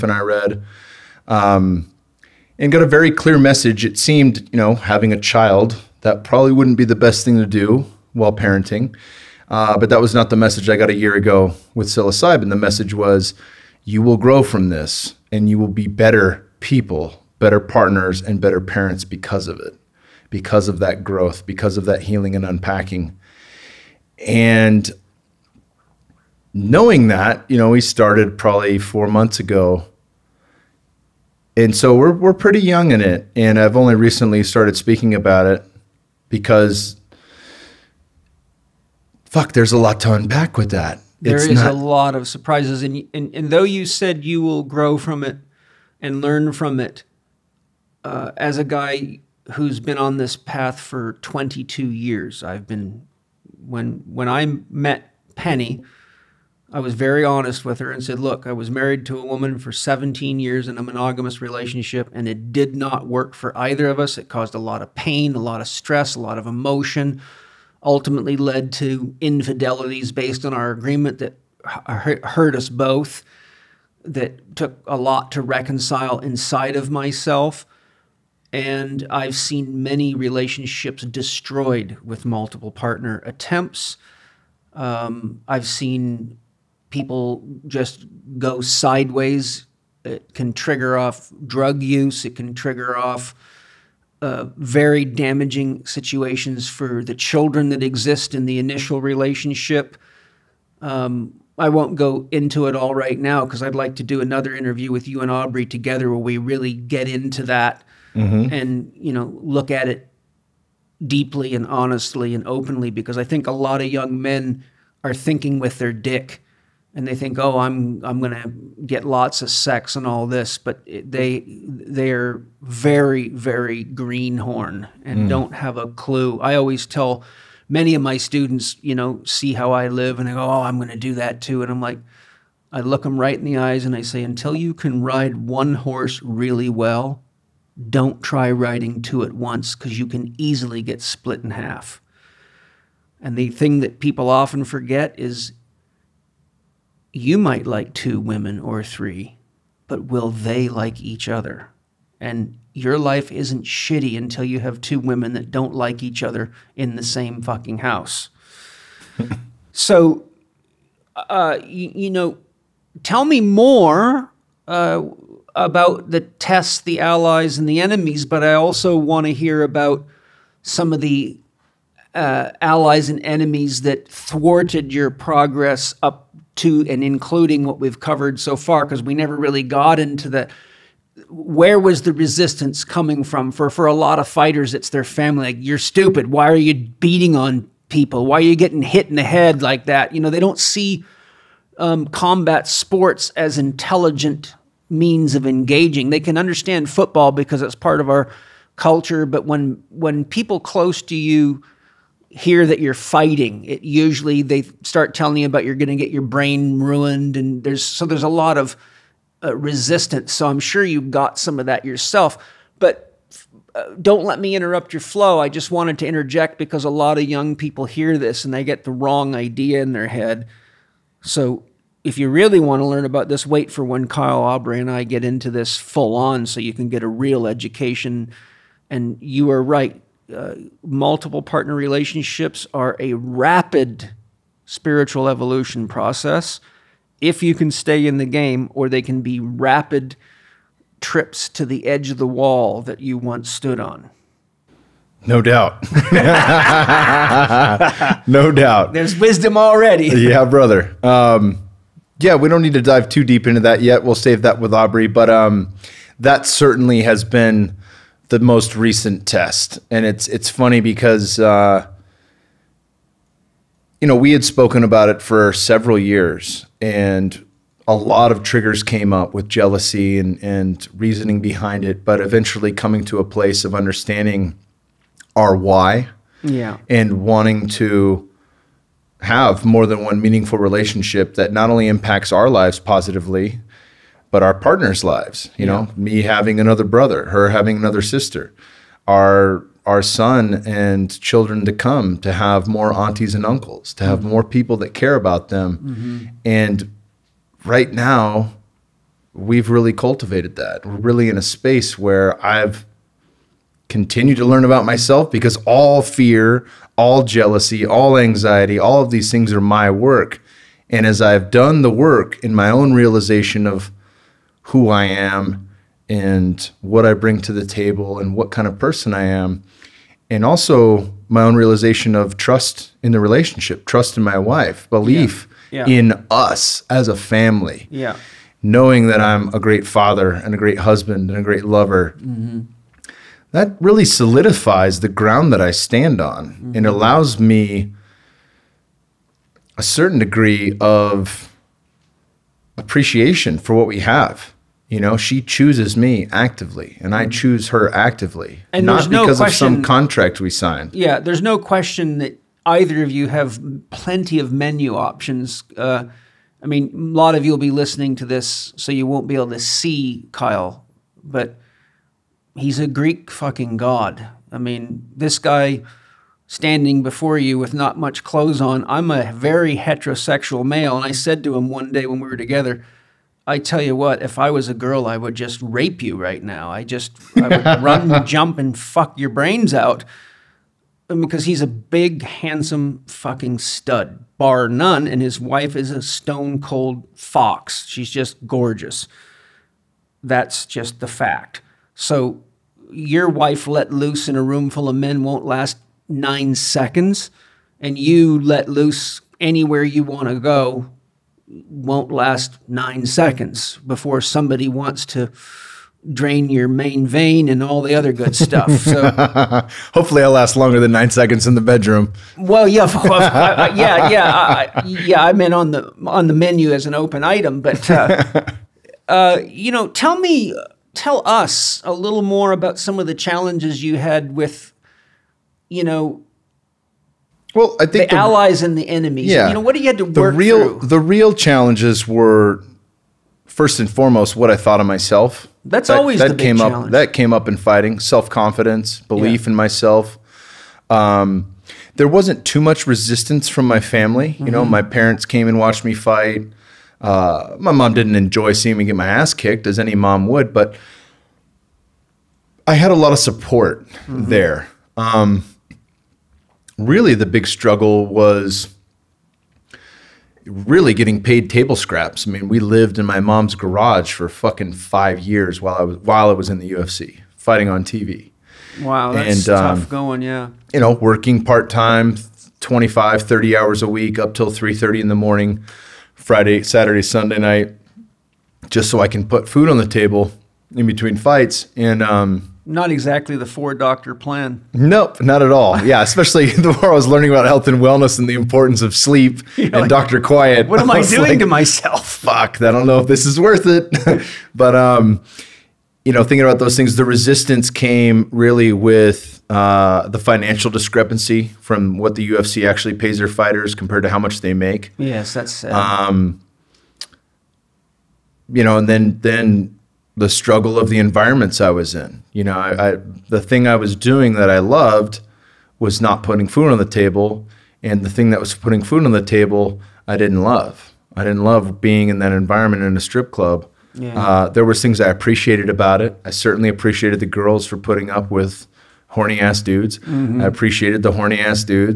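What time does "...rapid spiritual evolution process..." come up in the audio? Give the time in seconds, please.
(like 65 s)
233 s.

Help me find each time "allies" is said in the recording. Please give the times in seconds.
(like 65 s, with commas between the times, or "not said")
167 s, 172 s, 428 s.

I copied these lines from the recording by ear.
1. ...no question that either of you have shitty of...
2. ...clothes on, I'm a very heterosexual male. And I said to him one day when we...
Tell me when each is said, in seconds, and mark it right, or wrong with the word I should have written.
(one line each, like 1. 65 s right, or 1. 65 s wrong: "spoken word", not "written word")
1. 351 s wrong: "plenty", not "shitty"
2. 368 s right.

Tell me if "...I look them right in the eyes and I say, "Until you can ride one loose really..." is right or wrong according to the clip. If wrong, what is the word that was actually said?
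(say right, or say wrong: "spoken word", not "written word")
wrong: "horse", not "loose".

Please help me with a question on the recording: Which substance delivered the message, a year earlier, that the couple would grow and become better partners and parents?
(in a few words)
psilocybin.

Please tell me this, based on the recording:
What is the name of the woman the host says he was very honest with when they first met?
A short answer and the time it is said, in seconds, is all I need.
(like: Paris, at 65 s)
Penny, at 55 s.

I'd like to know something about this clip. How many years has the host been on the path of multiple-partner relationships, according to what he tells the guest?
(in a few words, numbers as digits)
22.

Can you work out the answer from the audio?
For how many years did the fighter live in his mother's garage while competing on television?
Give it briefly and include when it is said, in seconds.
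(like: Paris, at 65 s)
5, at 464 s.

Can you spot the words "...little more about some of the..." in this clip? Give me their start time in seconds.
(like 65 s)
421 s.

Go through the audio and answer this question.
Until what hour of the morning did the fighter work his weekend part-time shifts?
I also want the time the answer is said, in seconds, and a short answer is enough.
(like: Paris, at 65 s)
3:30, at 474 s.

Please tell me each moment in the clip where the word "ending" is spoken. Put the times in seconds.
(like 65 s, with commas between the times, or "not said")
not said.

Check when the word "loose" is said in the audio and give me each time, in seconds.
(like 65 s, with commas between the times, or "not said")
393 s, 398 s.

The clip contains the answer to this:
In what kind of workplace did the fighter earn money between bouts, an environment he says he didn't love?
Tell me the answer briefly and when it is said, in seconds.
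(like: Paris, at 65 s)
strip club, at 523 s.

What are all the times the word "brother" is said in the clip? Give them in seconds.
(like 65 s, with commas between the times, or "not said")
250 s, 286 s.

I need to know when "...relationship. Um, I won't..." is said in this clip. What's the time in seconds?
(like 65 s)
99 s.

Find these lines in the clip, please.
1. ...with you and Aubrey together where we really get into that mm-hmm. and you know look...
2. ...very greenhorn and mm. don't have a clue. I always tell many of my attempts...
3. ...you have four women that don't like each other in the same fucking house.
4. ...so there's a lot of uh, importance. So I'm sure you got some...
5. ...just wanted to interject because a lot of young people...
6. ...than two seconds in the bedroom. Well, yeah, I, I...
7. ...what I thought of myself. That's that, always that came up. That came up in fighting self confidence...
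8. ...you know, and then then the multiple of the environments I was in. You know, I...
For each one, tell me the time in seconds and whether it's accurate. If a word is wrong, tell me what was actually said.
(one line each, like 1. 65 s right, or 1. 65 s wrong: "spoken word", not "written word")
1. 104 s right
2. 123 s wrong: "students", not "attempts"
3. 154 s wrong: "two", not "four"
4. 207 s wrong: "resistance", not "importance"
5. 215 s right
6. 410 s wrong: "nine", not "two"
7. 434 s right
8. 508 s wrong: "struggle", not "multiple".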